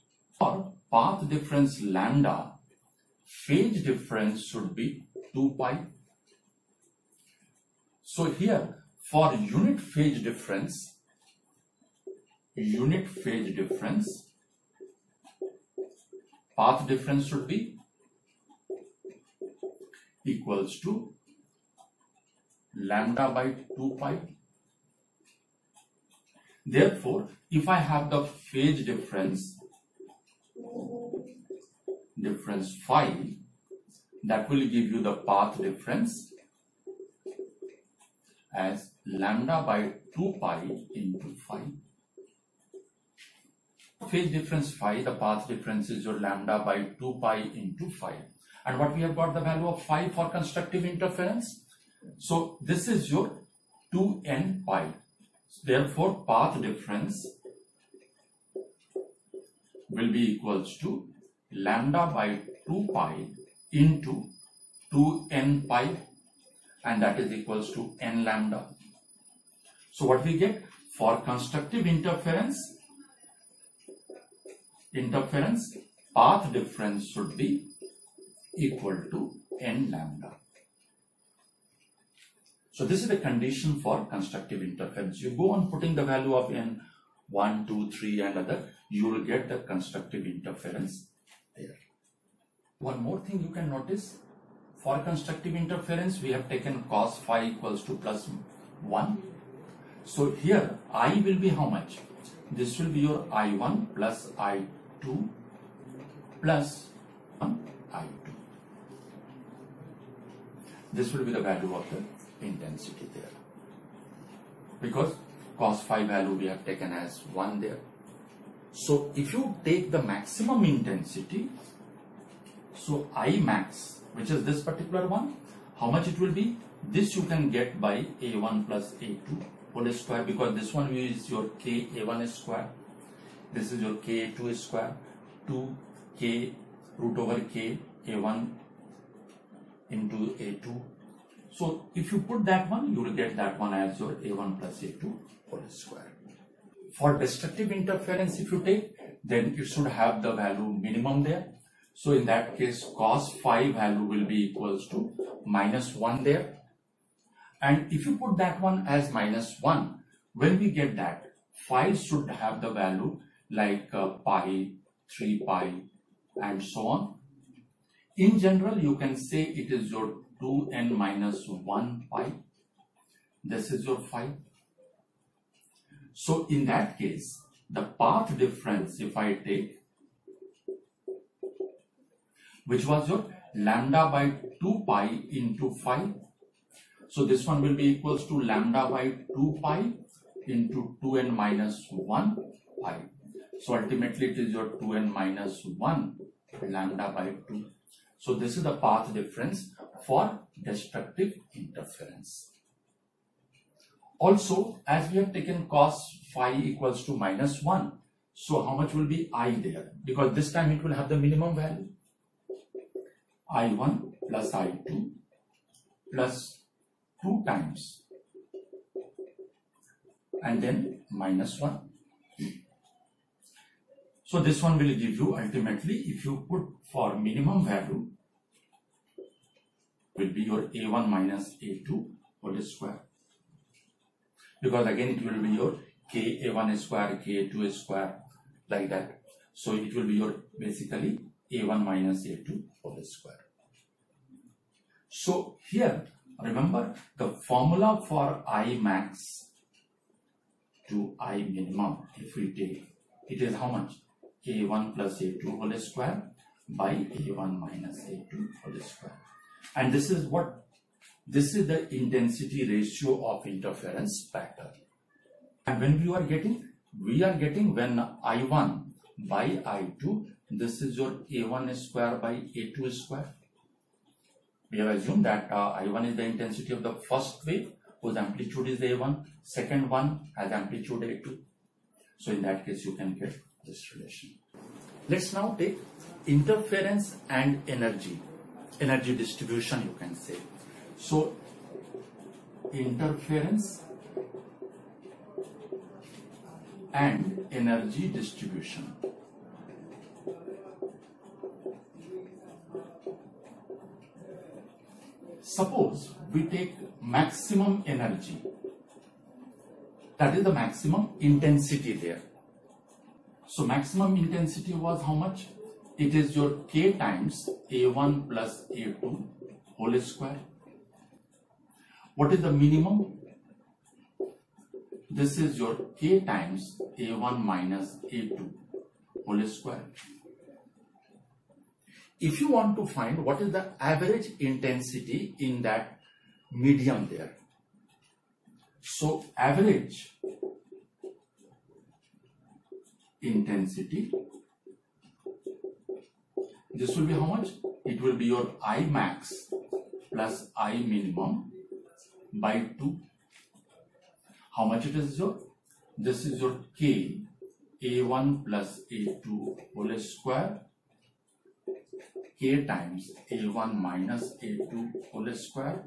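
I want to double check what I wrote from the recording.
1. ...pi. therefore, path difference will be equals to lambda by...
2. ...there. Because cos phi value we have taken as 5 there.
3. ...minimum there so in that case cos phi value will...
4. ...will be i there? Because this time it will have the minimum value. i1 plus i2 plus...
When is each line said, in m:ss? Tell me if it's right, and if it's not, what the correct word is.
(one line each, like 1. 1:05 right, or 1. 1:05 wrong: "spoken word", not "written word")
1. 0:54 right
2. 1:53 wrong: "1", not "5"
3. 2:30 right
4. 3:28 right.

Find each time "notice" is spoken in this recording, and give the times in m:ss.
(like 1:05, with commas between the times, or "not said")
1:33.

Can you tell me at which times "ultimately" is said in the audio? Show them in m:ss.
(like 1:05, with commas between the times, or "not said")
3:13, 3:45.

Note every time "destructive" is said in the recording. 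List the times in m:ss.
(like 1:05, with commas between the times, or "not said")
2:27, 3:20.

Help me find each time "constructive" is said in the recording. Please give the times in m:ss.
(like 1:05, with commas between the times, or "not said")
0:50, 1:11, 1:24, 1:29, 1:35.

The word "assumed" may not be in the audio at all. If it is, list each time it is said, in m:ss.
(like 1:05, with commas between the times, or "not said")
4:34.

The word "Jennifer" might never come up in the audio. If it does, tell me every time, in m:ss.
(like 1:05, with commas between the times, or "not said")
not said.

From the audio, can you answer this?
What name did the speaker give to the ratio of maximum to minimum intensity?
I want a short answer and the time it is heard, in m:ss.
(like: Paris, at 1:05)
intensity ratio, at 4:21.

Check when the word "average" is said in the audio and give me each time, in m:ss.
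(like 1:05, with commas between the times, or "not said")
5:33, 5:39.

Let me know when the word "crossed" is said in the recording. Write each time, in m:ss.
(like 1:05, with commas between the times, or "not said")
not said.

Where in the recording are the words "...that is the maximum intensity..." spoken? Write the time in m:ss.
5:10.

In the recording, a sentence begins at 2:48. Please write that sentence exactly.
In general, you can say it is your 2n minus 1 pi.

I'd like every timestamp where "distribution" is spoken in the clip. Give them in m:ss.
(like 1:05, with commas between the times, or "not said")
4:49, 4:58.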